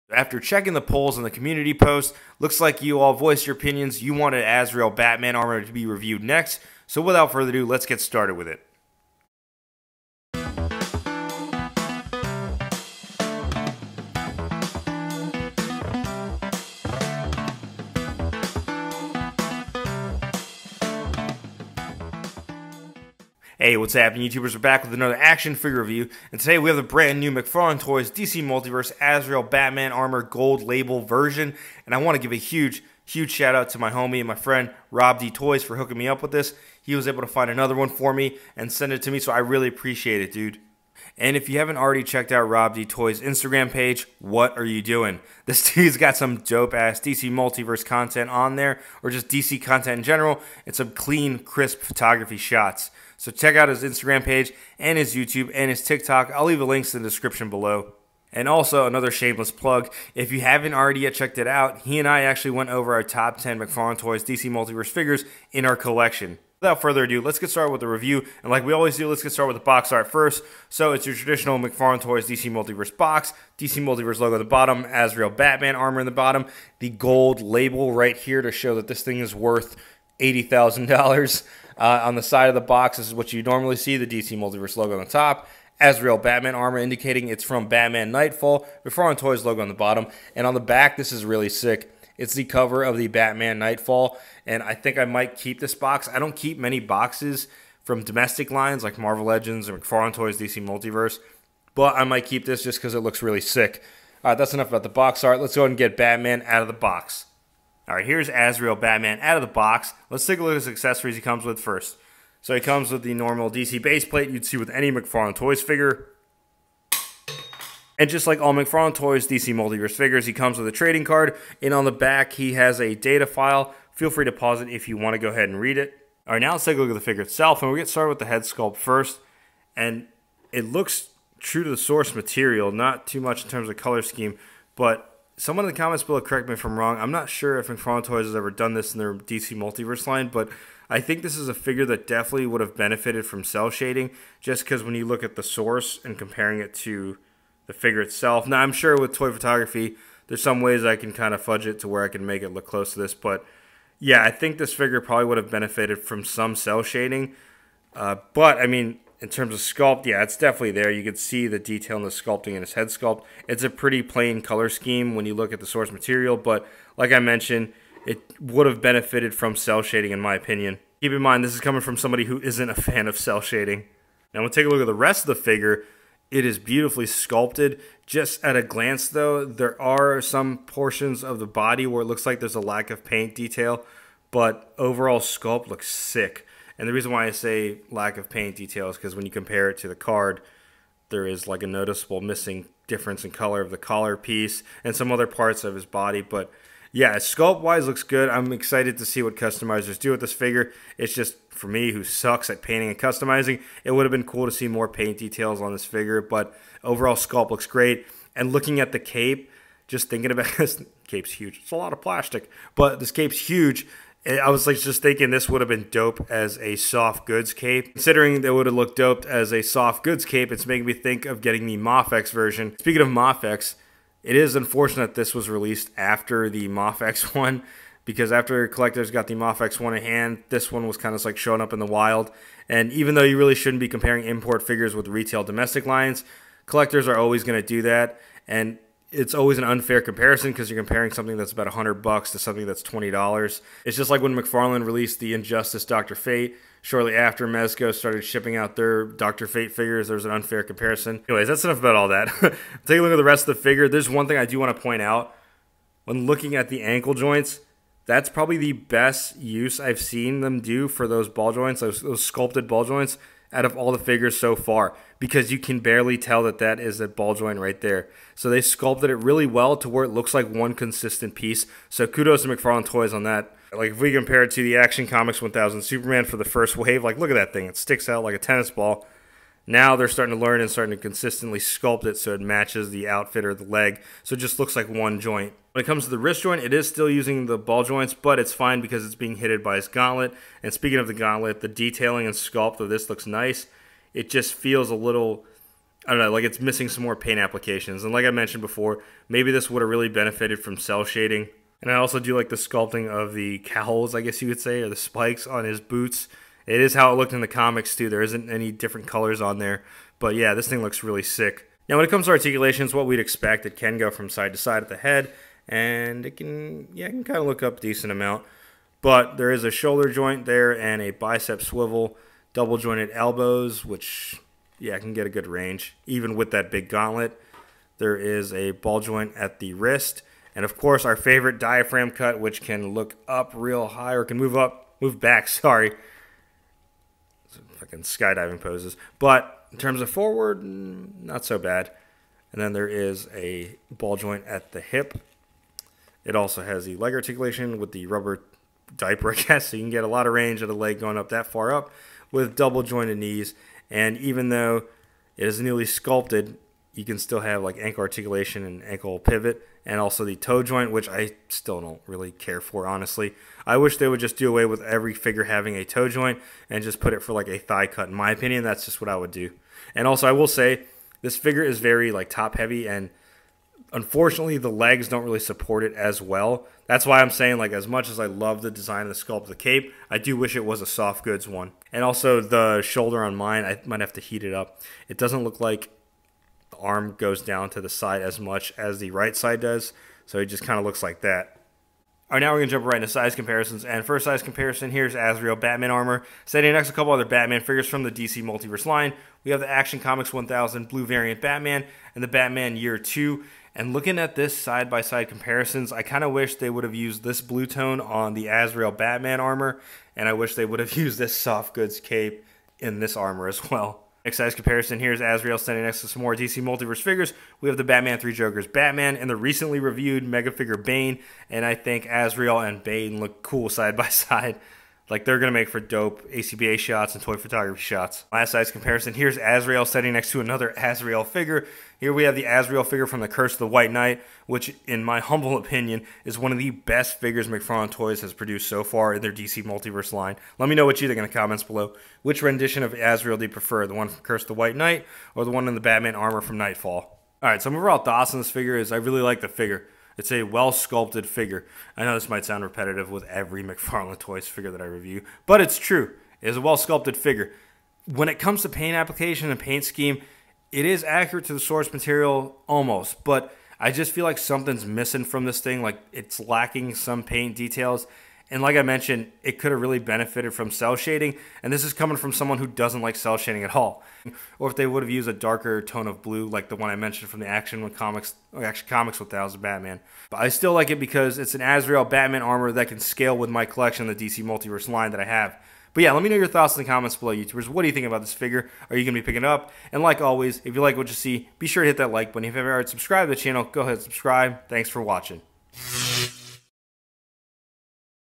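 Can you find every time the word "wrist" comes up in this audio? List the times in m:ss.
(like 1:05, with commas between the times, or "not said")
4:46, 5:29.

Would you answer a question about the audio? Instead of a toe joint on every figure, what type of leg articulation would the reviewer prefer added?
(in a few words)
thigh cut.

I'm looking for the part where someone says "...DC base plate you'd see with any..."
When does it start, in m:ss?
1:53.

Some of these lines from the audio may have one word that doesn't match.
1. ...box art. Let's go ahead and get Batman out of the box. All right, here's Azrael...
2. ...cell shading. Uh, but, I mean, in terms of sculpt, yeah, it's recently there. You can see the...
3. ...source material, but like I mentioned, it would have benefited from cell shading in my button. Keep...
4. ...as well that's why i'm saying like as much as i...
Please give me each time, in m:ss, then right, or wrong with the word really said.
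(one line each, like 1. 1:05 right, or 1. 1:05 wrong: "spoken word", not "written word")
1. 1:44 right
2. 2:36 wrong: "definitely", not "recently"
3. 2:45 wrong: "opinion", not "button"
4. 6:15 right.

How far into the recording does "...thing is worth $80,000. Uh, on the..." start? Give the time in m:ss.
1:19.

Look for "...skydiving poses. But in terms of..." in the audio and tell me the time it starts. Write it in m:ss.
5:38.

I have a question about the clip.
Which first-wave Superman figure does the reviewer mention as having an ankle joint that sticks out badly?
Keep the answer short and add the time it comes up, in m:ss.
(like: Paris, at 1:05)
Action Comics 1000 Superman, at 4:34.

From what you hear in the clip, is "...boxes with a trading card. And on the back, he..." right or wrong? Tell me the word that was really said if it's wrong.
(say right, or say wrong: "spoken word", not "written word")
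wrong: "comes", not "boxes".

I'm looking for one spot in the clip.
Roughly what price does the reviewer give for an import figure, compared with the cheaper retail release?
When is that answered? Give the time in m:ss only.
4:01.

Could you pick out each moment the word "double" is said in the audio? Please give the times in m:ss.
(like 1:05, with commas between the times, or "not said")
5:22, 5:52.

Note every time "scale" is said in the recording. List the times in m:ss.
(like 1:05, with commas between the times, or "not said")
8:02.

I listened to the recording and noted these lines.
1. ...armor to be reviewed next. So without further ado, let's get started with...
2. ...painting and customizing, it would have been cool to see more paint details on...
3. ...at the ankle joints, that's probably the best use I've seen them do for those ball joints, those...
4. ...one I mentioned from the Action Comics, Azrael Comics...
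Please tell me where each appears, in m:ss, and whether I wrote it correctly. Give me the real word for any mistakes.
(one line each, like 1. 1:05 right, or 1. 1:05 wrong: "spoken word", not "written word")
1. 0:05 right
2. 3:22 right
3. 4:16 right
4. 7:56 wrong: "Action", not "Azrael".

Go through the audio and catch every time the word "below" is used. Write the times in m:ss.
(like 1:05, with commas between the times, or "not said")
0:57, 2:16, 7:21, 8:07.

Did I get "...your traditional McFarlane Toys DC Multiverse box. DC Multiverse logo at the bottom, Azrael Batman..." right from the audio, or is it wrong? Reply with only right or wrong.
right.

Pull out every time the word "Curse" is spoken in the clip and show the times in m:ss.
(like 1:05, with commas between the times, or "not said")
7:13, 7:24.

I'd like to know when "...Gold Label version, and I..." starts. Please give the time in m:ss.
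0:30.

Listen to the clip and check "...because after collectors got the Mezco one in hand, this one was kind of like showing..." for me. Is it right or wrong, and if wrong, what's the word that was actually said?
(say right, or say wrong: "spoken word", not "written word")
wrong: "Mafex", not "Mezco".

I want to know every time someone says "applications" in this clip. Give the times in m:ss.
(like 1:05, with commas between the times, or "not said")
4:57, 7:38.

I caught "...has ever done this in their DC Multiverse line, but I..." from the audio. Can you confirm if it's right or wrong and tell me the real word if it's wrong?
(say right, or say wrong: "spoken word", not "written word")
right.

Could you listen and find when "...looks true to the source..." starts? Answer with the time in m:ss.
2:10.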